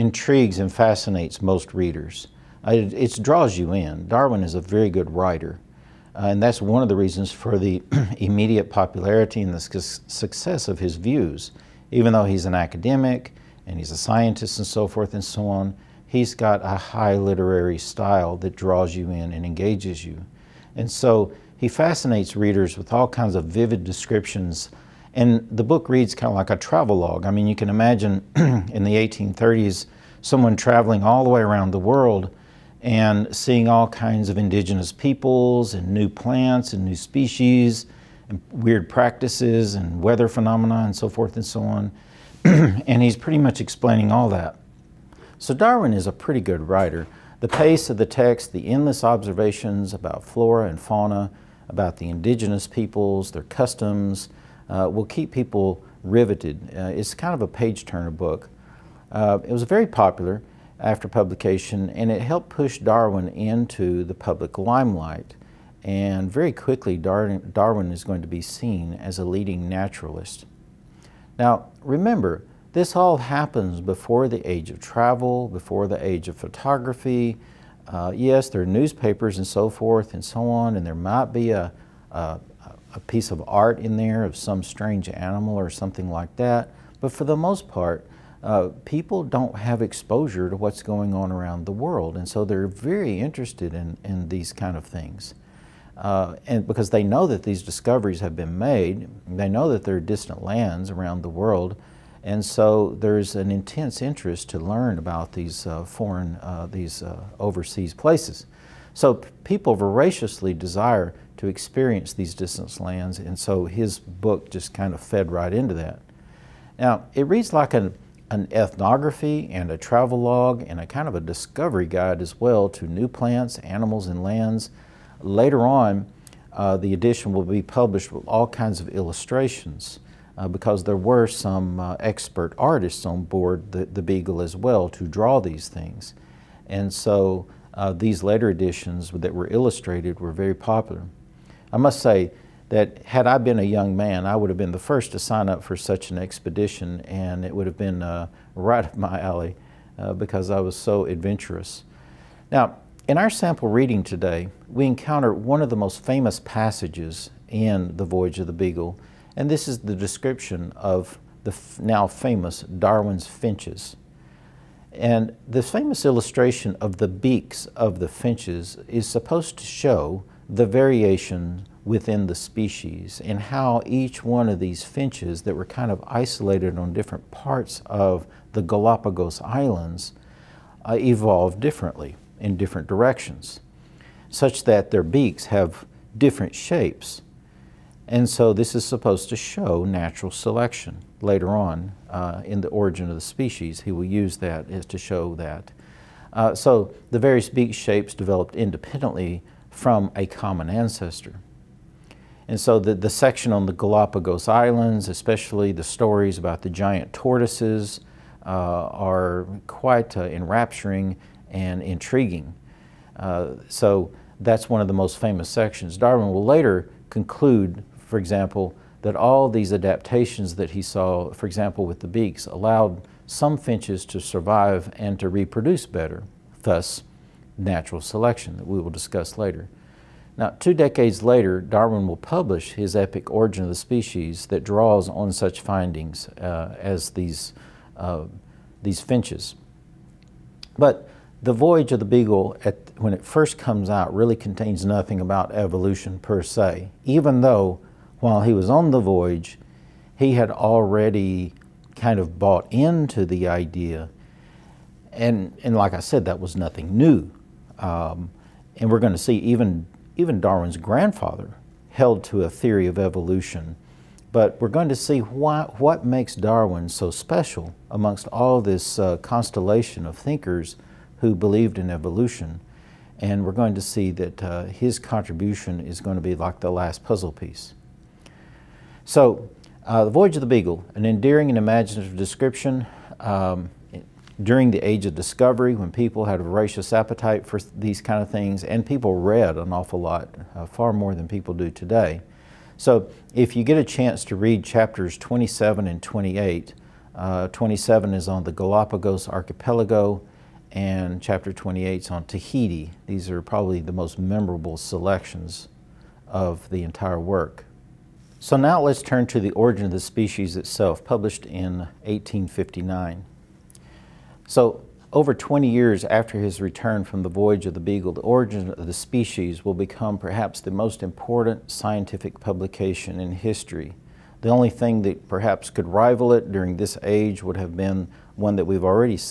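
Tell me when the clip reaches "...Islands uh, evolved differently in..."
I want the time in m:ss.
2:59.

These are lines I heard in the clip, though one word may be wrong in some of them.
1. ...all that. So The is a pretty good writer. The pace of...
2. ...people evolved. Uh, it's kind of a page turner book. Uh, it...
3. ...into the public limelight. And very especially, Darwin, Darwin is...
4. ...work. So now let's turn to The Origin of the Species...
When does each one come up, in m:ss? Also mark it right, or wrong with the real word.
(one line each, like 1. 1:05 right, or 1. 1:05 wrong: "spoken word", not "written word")
1. 0:44 wrong: "Darwin", not "The"
2. 0:55 wrong: "riveted", not "evolved"
3. 1:03 wrong: "quickly", not "especially"
4. 5:07 right.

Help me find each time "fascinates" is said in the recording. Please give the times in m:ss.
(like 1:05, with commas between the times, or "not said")
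0:00, 0:21.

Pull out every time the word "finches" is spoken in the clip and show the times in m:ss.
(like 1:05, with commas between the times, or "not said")
2:43, 2:48, 2:54, 3:43, 3:58.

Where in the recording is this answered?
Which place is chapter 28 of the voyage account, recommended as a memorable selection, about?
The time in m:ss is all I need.
5:02.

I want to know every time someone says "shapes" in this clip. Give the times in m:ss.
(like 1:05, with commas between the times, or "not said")
3:06, 3:17.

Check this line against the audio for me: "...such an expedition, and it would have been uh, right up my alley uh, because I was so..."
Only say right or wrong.
right.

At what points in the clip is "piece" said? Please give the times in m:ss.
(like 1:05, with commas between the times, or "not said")
1:22, 4:37.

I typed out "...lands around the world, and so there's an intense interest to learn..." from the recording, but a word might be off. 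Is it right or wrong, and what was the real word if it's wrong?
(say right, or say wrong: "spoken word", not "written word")
right.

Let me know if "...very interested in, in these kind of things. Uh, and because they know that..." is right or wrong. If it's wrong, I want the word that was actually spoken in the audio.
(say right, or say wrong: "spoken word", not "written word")
right.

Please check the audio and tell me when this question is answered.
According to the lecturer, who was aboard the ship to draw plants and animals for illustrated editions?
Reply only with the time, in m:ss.
2:11.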